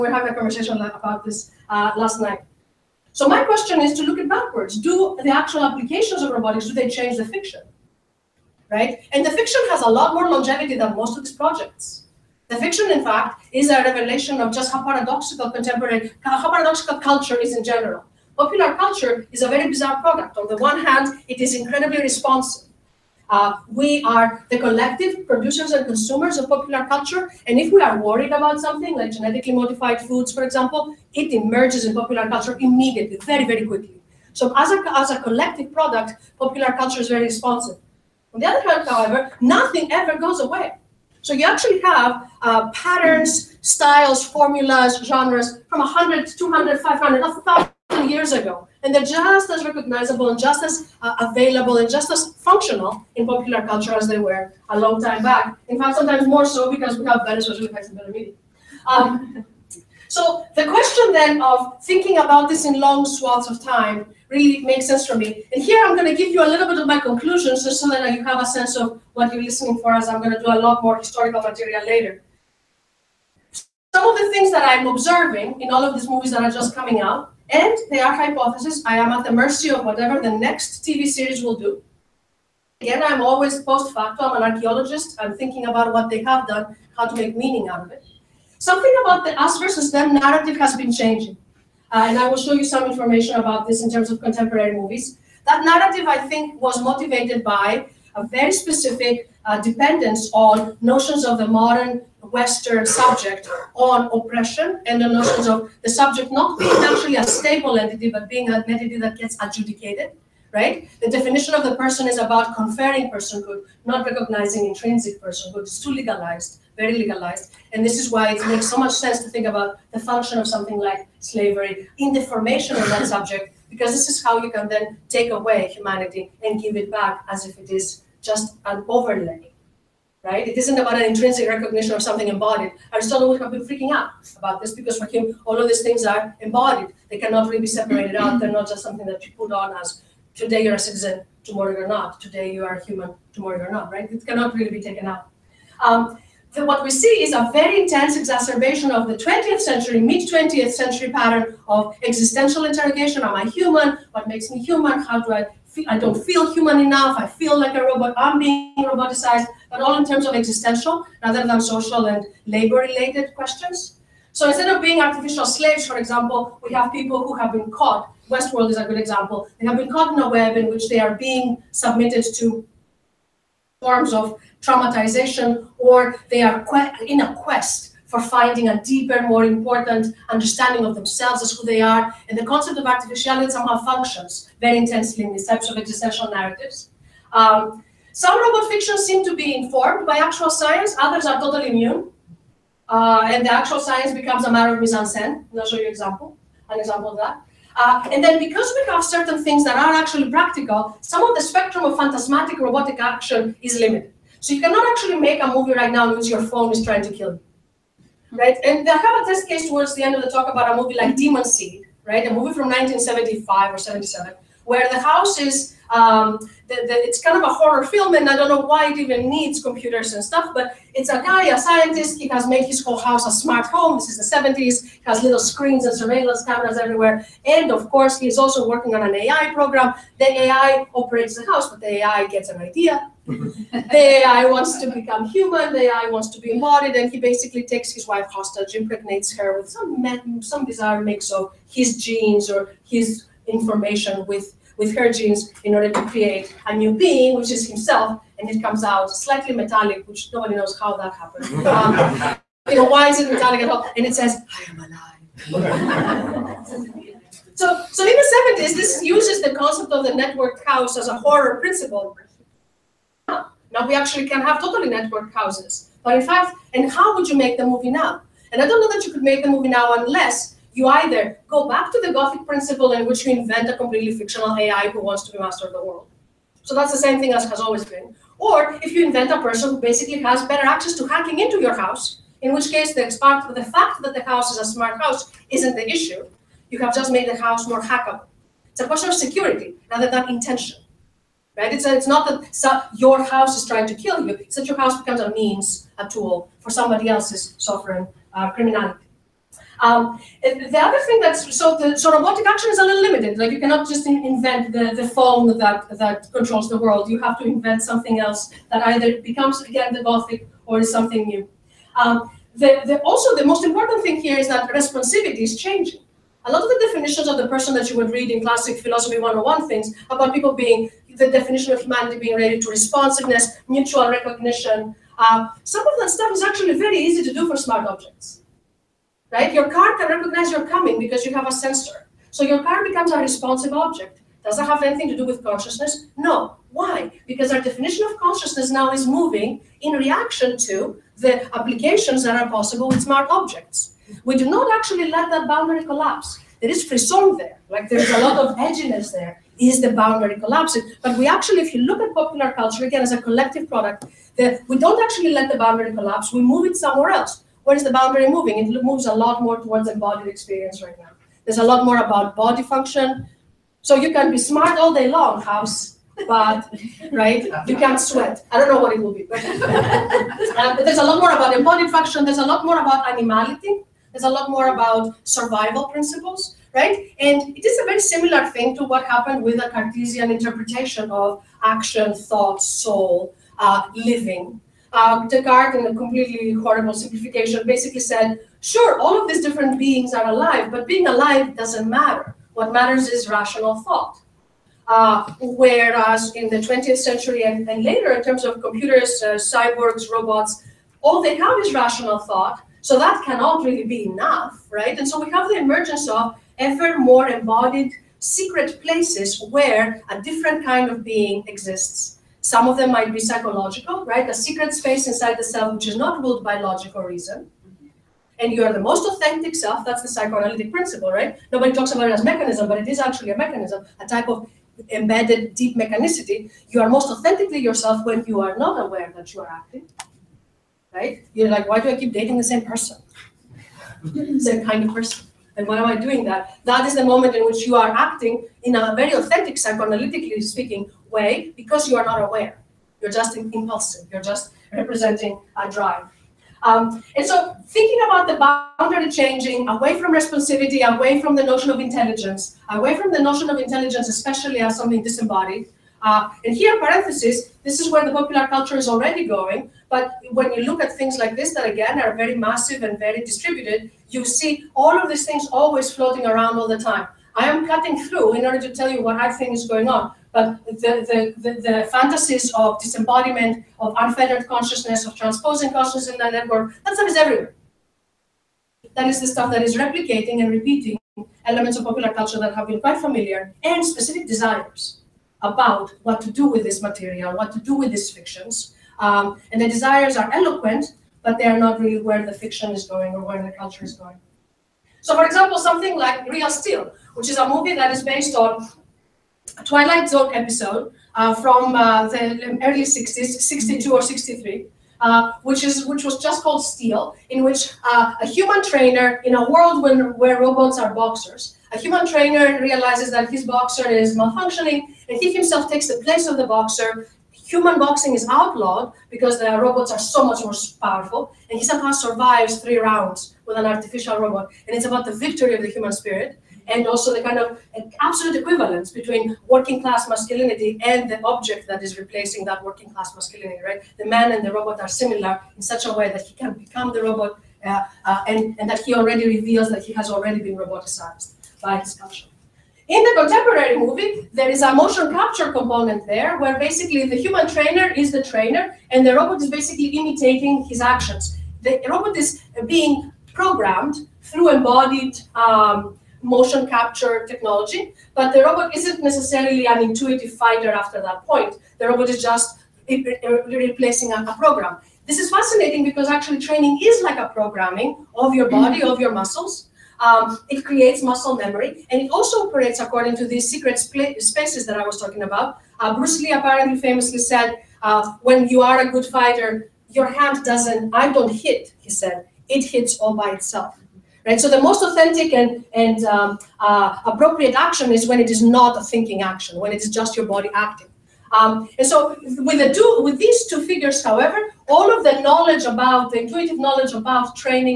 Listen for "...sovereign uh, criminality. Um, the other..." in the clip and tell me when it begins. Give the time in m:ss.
4:57.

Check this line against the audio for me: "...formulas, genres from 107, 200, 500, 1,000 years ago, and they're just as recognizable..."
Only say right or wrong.
wrong.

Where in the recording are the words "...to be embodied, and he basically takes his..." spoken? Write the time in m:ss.
3:56.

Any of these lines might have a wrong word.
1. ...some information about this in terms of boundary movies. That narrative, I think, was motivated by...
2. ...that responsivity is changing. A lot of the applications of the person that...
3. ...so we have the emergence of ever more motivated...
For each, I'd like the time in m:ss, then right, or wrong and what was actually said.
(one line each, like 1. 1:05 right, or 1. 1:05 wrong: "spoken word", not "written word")
1. 1:32 wrong: "contemporary", not "boundary"
2. 5:14 wrong: "definitions", not "applications"
3. 6:45 wrong: "embodied", not "motivated".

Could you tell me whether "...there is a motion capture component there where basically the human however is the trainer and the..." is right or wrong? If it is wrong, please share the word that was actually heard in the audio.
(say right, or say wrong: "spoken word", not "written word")
wrong: "trainer", not "however".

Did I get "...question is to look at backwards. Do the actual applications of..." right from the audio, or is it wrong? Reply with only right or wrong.
right.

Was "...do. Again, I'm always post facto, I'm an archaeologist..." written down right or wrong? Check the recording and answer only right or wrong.
right.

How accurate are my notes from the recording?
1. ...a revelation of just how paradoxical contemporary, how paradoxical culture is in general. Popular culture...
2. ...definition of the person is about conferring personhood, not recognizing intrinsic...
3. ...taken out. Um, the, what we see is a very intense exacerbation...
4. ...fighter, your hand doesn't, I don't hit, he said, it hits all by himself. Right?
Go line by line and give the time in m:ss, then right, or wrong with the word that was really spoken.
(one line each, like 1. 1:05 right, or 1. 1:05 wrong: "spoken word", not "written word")
1. 0:13 right
2. 1:51 right
3. 2:24 right
4. 9:39 wrong: "itself", not "himself".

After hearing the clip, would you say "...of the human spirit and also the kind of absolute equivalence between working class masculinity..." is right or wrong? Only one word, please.
right.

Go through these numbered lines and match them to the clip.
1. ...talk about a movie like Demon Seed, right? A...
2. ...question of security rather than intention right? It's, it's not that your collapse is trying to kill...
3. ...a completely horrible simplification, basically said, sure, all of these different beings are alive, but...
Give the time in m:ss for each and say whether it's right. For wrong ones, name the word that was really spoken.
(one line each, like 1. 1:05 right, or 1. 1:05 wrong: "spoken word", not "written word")
1. 3:30 right
2. 4:48 wrong: "house", not "collapse"
3. 6:25 right.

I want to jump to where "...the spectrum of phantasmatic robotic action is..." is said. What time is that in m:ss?
3:21.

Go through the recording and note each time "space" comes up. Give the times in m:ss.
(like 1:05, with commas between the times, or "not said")
6:54, 9:33.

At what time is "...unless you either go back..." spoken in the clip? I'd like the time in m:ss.
4:29.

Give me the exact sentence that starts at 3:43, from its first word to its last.
This is the 70s, he has little screens and surveillance cameras everywhere.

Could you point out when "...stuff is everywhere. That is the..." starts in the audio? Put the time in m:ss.
7:56.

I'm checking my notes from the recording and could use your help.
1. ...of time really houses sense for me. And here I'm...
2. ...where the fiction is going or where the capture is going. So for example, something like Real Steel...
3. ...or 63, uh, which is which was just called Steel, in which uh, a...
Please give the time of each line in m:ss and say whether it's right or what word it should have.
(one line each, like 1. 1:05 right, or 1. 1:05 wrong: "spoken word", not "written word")
1. 1:03 wrong: "makes", not "houses"
2. 8:12 wrong: "culture", not "capture"
3. 8:23 right.